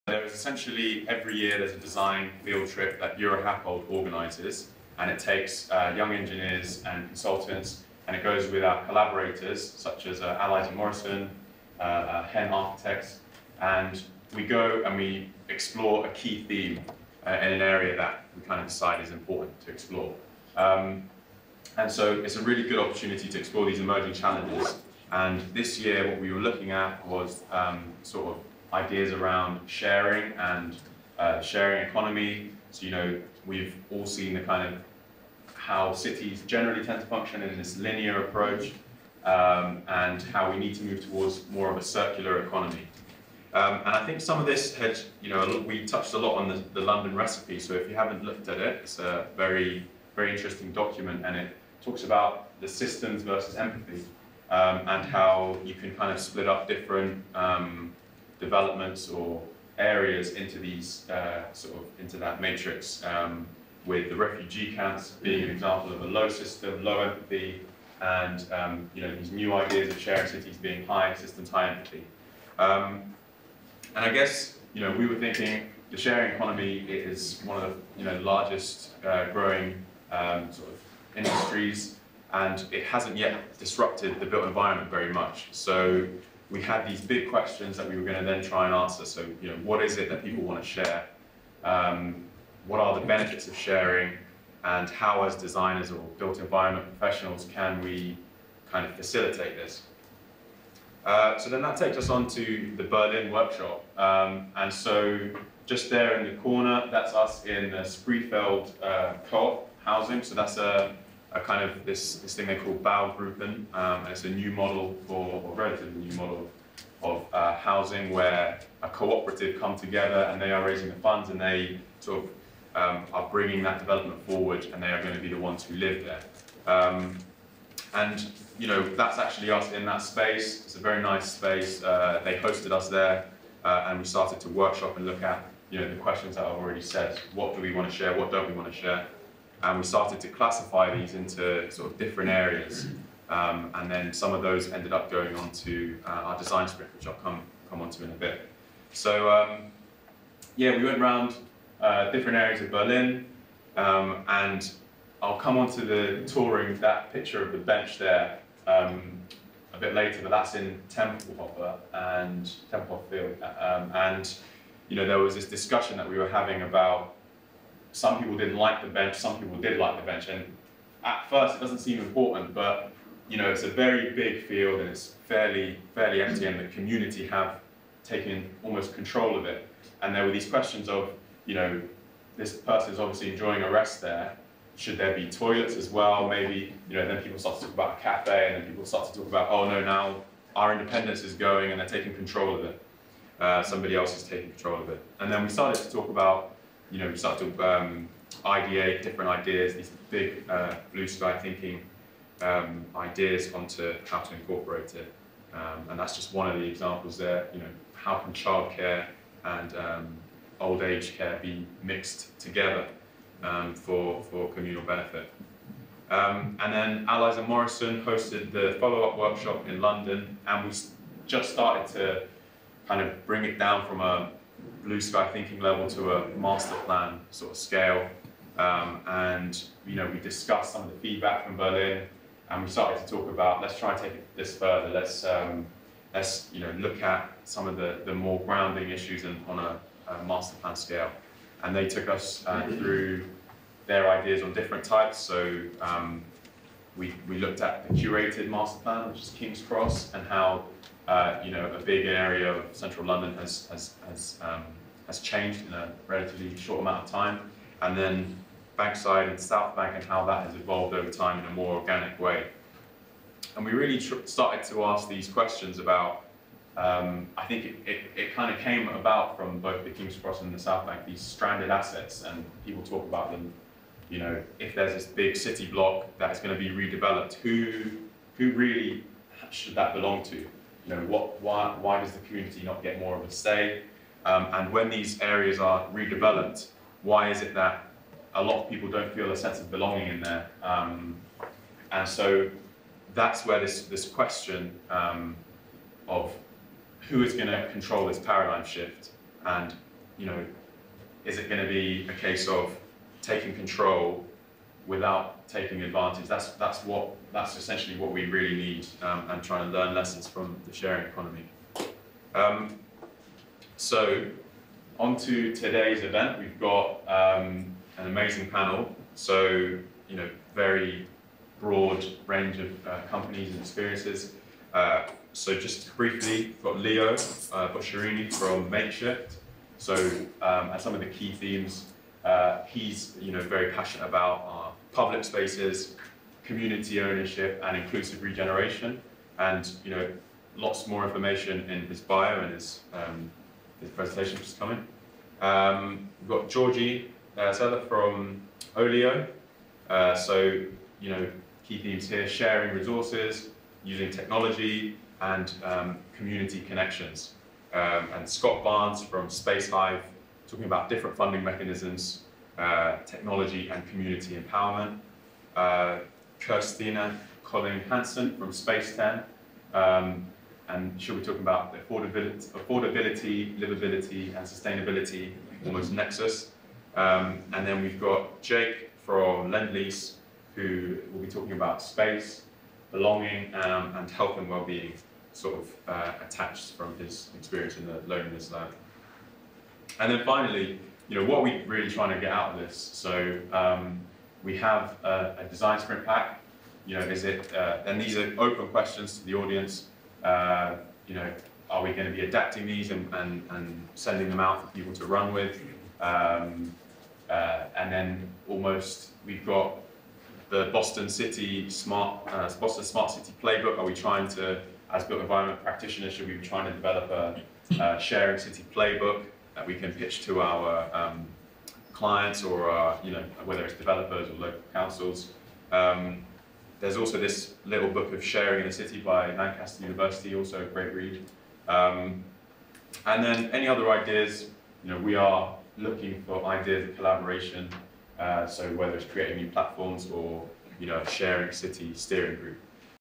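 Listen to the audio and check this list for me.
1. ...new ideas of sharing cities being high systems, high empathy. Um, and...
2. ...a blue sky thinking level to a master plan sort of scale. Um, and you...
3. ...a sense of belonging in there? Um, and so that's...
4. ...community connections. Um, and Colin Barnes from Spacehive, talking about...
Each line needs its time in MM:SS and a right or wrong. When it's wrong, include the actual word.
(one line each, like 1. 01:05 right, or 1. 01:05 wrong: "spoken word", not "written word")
1. 01:09 right
2. 03:44 right
3. 04:49 right
4. 05:56 wrong: "Scott", not "Colin".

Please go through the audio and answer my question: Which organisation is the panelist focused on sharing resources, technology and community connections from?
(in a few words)
Olio.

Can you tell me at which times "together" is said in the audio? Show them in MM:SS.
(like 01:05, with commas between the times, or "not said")
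01:59, 03:32.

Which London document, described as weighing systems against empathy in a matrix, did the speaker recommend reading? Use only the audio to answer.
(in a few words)
The London recipe.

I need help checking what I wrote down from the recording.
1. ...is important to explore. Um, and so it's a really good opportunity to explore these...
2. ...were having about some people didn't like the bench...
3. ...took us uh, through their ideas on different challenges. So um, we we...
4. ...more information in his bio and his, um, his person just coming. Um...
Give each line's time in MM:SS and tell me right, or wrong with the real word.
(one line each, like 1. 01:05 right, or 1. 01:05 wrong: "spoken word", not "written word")
1. 00:19 right
2. 02:46 right
3. 04:01 wrong: "types", not "challenges"
4. 05:40 wrong: "presentation", not "person".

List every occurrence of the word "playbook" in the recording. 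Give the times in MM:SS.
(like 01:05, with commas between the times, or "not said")
06:53, 06:58.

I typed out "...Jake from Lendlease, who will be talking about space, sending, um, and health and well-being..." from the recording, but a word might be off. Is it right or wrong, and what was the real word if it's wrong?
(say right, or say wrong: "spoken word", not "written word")
wrong: "belonging", not "sending".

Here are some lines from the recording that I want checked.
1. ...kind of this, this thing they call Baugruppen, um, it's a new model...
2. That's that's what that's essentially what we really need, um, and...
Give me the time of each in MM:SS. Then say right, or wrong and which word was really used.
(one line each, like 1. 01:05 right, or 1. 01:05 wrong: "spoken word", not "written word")
1. 01:51 right
2. 05:06 right.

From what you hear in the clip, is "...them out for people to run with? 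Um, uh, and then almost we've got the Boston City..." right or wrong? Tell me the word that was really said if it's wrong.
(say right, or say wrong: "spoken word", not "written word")
right.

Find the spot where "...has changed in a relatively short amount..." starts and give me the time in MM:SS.
04:15.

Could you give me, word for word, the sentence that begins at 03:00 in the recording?
And there were these questions of, you know, this person is obviously enjoying a rest there.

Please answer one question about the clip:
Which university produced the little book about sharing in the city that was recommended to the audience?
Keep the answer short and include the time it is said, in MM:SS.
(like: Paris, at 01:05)
Lancaster University, at 07:09.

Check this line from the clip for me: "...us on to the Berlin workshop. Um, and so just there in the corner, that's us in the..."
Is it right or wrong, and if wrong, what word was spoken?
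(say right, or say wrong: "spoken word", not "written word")
right.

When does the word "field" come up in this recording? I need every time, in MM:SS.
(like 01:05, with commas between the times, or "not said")
00:02, 02:43, 02:54.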